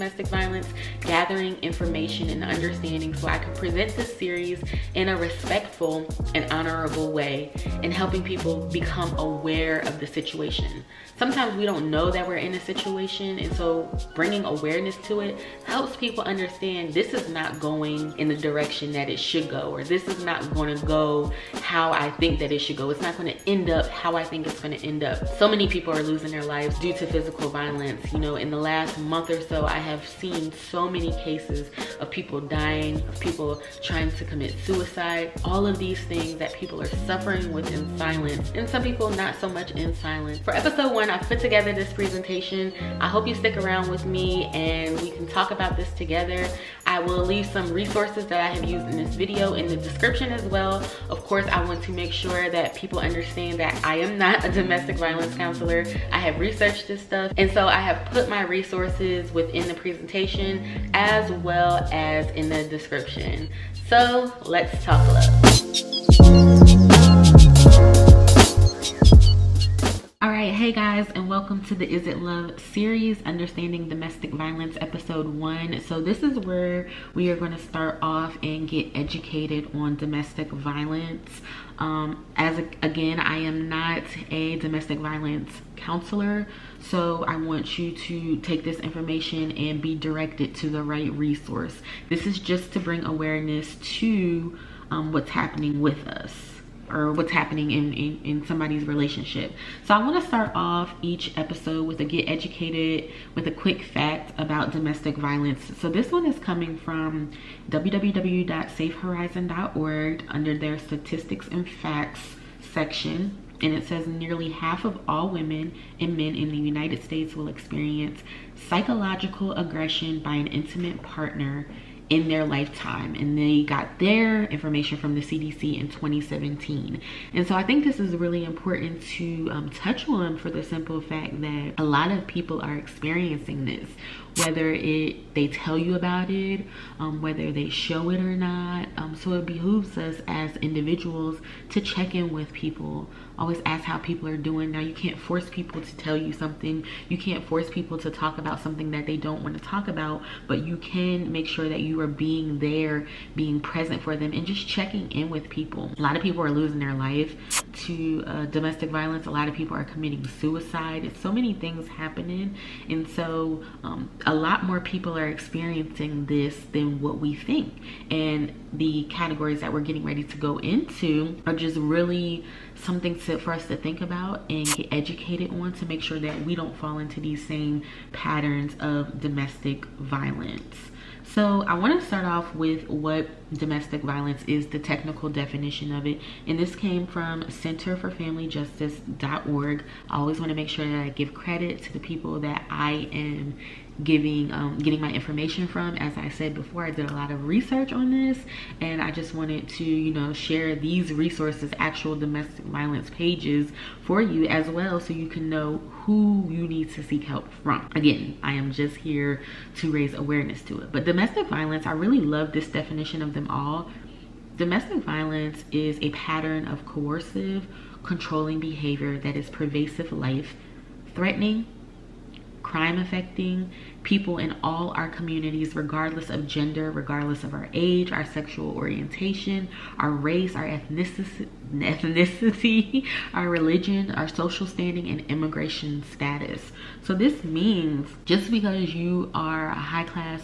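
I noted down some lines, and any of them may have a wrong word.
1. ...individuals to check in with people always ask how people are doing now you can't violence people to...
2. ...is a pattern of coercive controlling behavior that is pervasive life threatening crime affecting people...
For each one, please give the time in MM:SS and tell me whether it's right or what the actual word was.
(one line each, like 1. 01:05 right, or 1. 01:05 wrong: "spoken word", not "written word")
1. 02:20 wrong: "force", not "violence"
2. 03:35 right.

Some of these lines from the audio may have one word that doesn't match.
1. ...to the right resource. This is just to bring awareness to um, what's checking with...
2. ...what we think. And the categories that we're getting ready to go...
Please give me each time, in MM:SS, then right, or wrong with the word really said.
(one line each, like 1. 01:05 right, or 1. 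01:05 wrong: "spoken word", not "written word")
1. 01:30 wrong: "happening", not "checking"
2. 02:47 right.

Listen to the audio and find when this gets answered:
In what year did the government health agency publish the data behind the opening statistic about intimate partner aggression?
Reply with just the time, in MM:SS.
02:05.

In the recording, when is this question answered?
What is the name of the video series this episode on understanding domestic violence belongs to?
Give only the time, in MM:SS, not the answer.
01:11.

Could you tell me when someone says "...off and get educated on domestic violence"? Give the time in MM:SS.
01:18.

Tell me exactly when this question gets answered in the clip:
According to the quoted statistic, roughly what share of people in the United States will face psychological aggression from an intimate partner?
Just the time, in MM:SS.
01:54.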